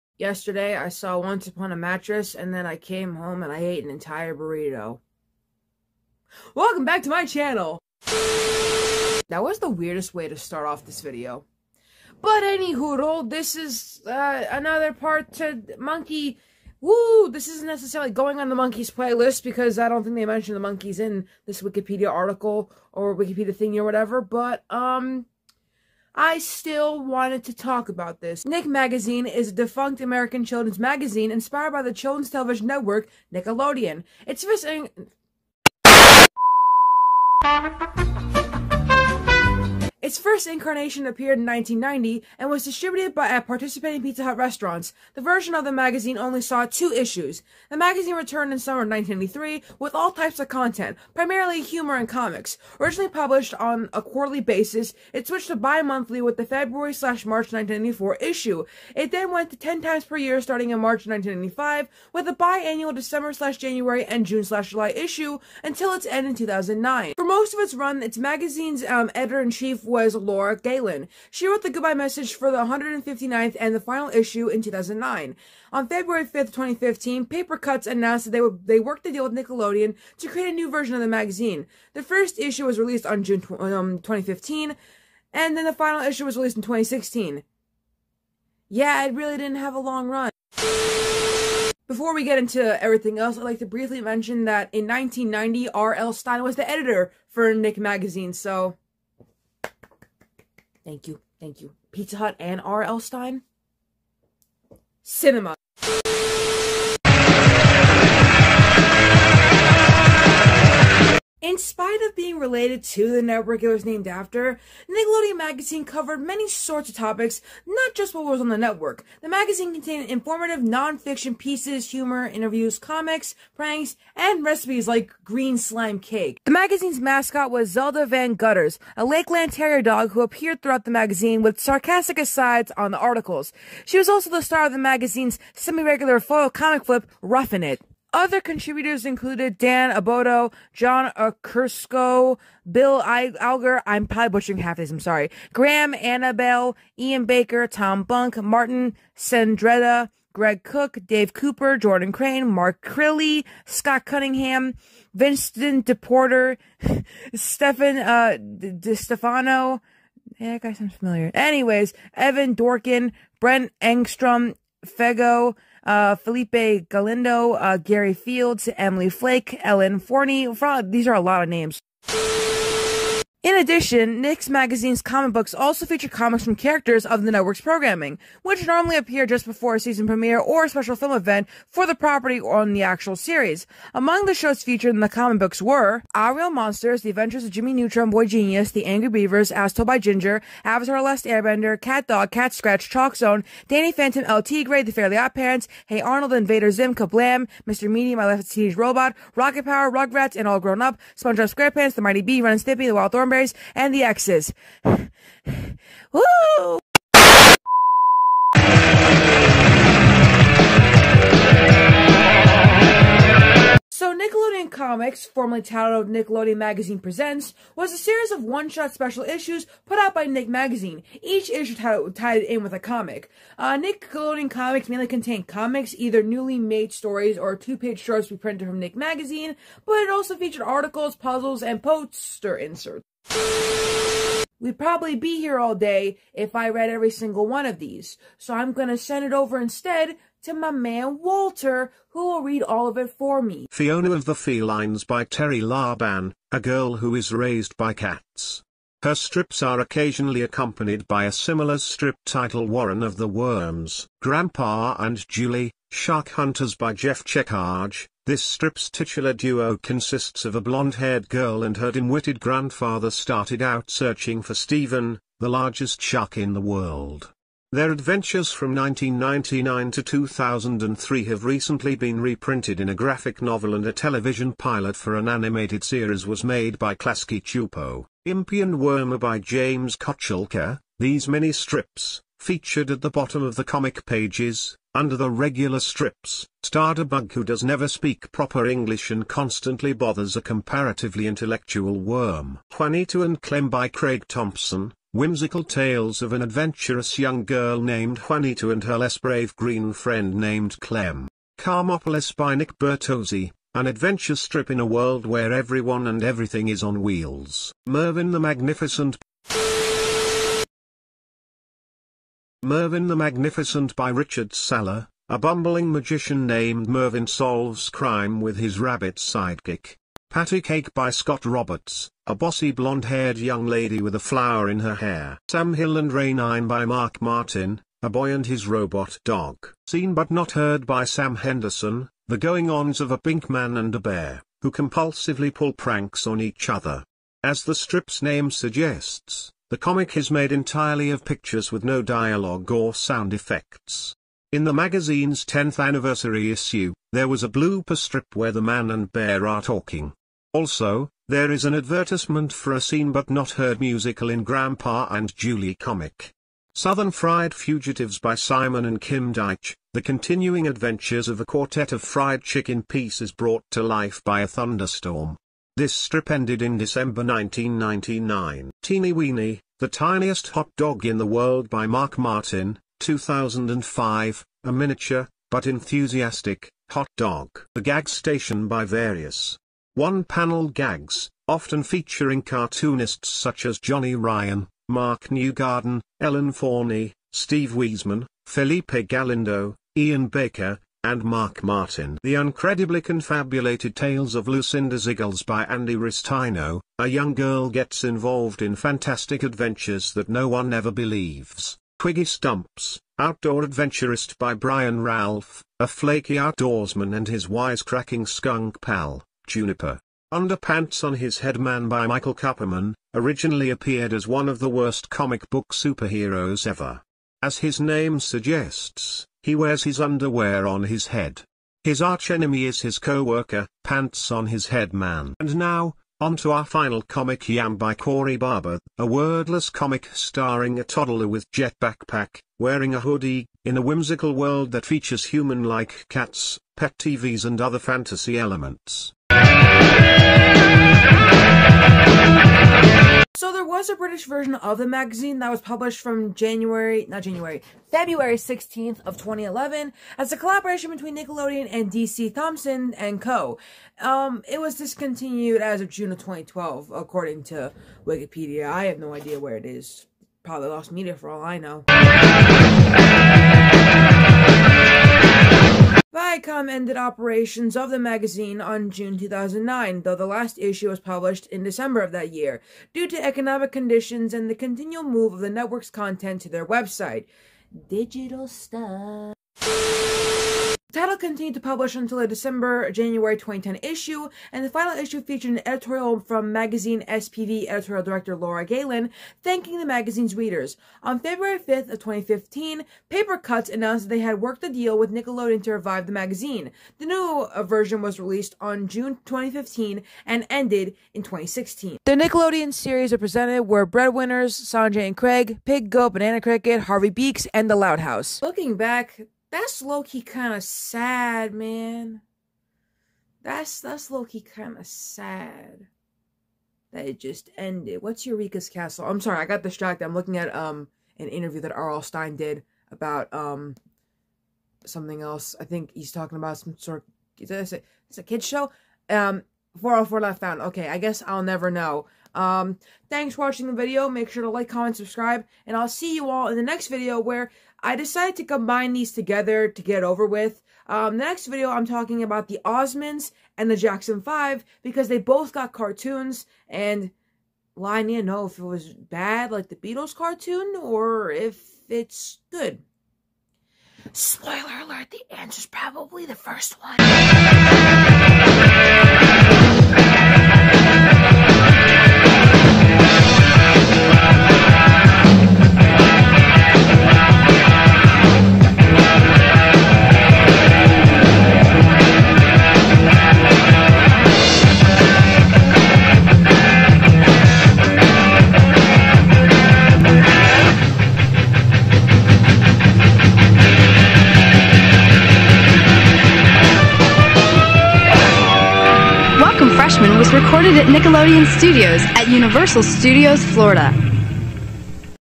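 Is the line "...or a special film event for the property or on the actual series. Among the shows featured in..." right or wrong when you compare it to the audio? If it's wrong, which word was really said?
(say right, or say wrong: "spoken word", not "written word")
right.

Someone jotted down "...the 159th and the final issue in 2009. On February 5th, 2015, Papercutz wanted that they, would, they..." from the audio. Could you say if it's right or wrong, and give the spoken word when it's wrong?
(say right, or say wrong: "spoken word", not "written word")
wrong: "announced", not "wanted".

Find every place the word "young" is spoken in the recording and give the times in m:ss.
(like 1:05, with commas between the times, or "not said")
4:57, 5:23, 6:37.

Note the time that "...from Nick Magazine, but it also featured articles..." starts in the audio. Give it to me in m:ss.
3:48.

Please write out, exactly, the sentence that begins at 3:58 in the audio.
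So I'm going to send it over instead to my man Walter, who will read all of it for me.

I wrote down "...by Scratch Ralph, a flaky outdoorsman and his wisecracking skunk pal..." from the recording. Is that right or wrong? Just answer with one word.
wrong.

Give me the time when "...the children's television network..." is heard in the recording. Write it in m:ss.
0:31.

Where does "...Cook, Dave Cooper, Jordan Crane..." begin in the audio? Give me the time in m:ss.
2:30.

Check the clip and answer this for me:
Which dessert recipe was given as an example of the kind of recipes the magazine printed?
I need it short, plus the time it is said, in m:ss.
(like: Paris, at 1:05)
green slime cake, at 2:05.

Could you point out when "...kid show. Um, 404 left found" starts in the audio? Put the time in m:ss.
8:48.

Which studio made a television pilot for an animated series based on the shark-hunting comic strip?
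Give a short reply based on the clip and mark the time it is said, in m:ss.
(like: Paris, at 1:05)
Klasky Csupo, at 4:36.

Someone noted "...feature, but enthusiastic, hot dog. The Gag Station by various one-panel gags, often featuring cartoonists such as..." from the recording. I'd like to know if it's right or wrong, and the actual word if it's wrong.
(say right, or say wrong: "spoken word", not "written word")
wrong: "miniature", not "feature".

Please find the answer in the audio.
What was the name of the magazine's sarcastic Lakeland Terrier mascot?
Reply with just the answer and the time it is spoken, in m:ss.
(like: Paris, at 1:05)
Zelda Van Gutters, at 2:07.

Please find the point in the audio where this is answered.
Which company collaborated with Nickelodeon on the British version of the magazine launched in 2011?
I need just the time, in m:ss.
7:31.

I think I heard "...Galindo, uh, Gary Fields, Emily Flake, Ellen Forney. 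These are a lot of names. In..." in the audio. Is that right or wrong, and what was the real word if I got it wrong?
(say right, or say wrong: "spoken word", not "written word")
right.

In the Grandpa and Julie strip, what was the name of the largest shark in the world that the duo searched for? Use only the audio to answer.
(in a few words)
Stephen.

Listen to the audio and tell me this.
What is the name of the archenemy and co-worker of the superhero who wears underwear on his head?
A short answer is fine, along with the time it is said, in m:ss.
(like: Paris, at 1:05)
Pants on His Head Man, at 7:03.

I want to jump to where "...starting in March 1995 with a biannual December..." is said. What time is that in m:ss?
1:00.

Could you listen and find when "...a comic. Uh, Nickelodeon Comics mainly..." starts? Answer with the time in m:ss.
3:42.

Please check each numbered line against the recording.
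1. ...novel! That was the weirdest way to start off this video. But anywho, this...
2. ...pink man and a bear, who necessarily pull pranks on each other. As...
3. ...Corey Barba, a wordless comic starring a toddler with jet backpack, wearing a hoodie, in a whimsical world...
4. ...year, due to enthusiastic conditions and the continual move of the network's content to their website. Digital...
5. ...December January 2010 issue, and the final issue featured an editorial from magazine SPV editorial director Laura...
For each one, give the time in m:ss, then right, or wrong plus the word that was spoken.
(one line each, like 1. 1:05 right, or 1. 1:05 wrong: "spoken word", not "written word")
1. 0:07 wrong: "channel", not "novel"
2. 5:33 wrong: "compulsively", not "necessarily"
3. 7:07 right
4. 7:52 wrong: "economic", not "enthusiastic"
5. 8:02 right.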